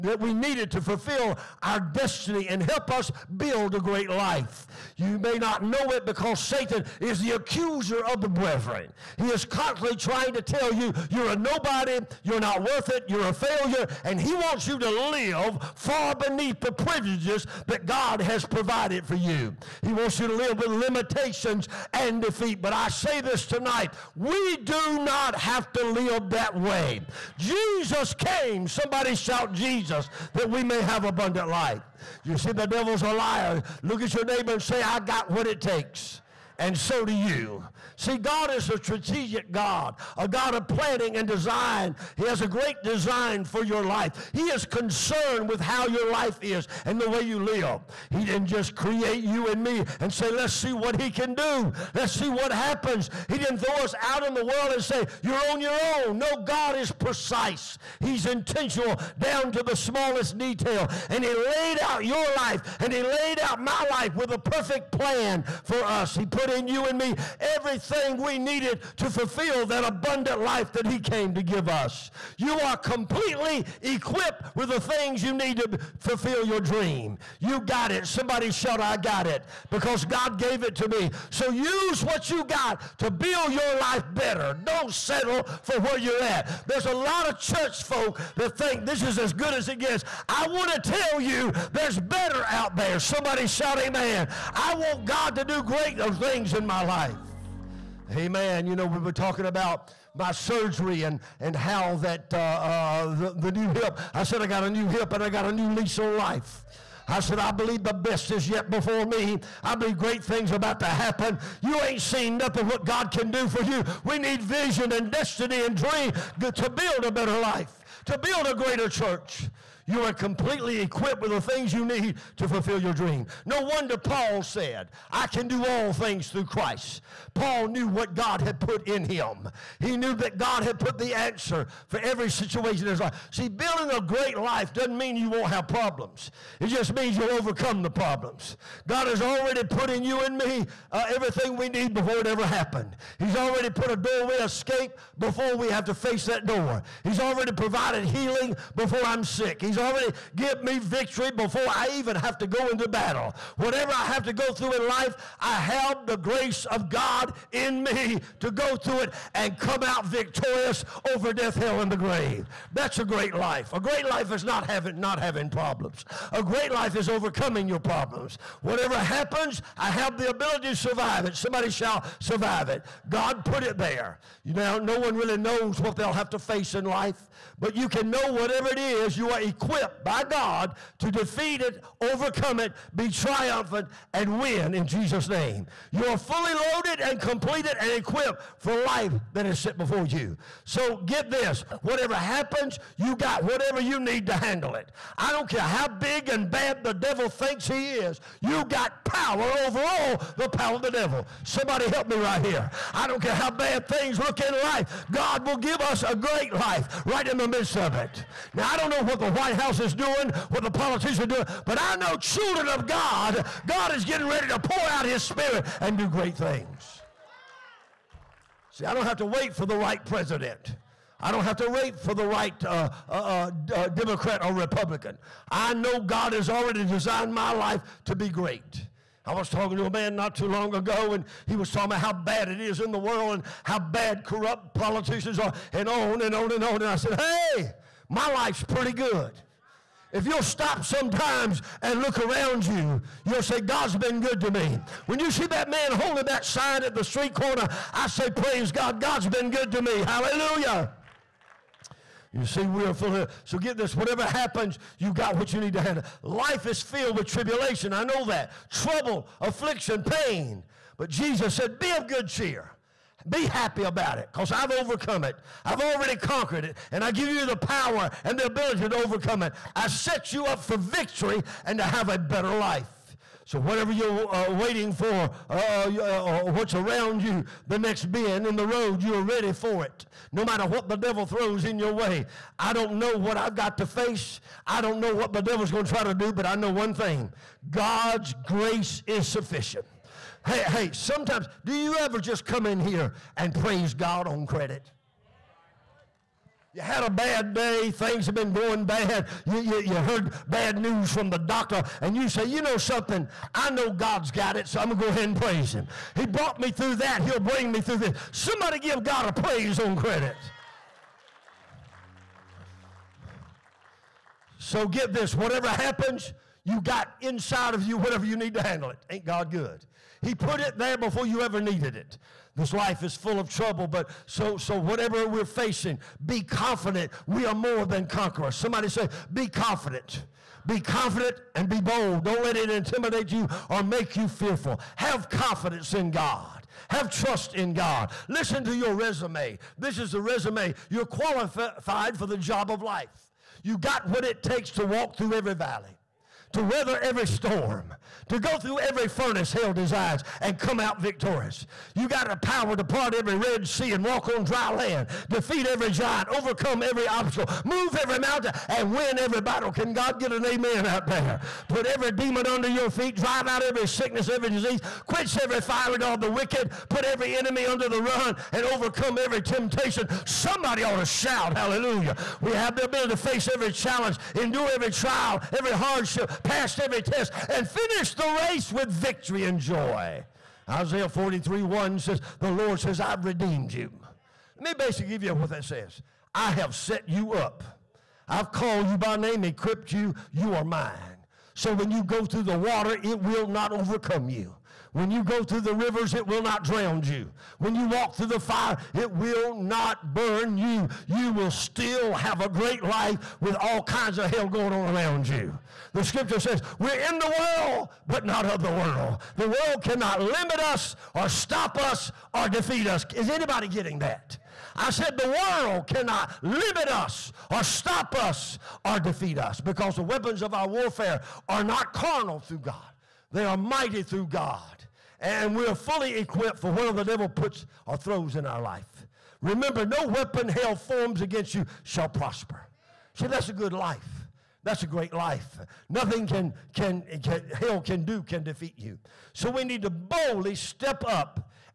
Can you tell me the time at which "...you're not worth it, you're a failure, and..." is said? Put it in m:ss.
0:12.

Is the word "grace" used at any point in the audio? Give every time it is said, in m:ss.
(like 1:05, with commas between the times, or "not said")
2:36, 4:48.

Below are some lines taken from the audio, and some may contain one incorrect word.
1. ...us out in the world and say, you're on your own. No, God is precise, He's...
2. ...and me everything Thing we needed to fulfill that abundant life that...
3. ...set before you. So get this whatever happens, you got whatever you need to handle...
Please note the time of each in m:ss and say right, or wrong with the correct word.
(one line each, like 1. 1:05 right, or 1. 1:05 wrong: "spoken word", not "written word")
1. 0:53 right
2. 1:06 right
3. 3:09 right.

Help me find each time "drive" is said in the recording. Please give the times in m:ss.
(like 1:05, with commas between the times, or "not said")
6:03.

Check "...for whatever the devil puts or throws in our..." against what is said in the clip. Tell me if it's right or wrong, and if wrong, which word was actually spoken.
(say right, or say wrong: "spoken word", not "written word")
right.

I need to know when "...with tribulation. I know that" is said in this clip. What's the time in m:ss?
4:17.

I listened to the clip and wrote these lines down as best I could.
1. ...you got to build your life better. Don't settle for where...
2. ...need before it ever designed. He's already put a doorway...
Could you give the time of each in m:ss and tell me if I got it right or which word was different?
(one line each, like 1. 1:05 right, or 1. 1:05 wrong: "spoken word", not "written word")
1. 1:22 right
2. 2:21 wrong: "happened", not "designed".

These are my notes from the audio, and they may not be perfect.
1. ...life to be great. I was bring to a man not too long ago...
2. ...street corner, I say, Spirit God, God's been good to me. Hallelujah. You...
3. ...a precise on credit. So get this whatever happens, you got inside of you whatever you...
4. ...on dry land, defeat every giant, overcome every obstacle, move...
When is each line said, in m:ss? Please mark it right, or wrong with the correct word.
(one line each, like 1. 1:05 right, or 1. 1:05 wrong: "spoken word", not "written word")
1. 3:47 wrong: "talking", not "bring"
2. 4:07 wrong: "Praise", not "Spirit"
3. 5:09 wrong: "praise", not "precise"
4. 5:54 right.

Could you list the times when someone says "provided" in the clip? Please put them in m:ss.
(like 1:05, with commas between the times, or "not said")
0:18, 2:27.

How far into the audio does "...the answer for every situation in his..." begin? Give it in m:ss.
2:10.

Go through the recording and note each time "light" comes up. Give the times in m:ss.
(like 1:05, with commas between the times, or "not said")
not said.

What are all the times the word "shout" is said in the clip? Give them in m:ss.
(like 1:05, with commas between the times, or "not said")
0:29, 1:18, 1:33, 6:11.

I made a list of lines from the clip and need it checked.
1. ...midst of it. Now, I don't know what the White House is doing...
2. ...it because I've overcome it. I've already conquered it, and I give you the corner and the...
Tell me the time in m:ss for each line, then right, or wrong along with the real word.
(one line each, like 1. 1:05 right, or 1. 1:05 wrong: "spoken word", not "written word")
1. 3:27 right
2. 4:24 wrong: "power", not "corner".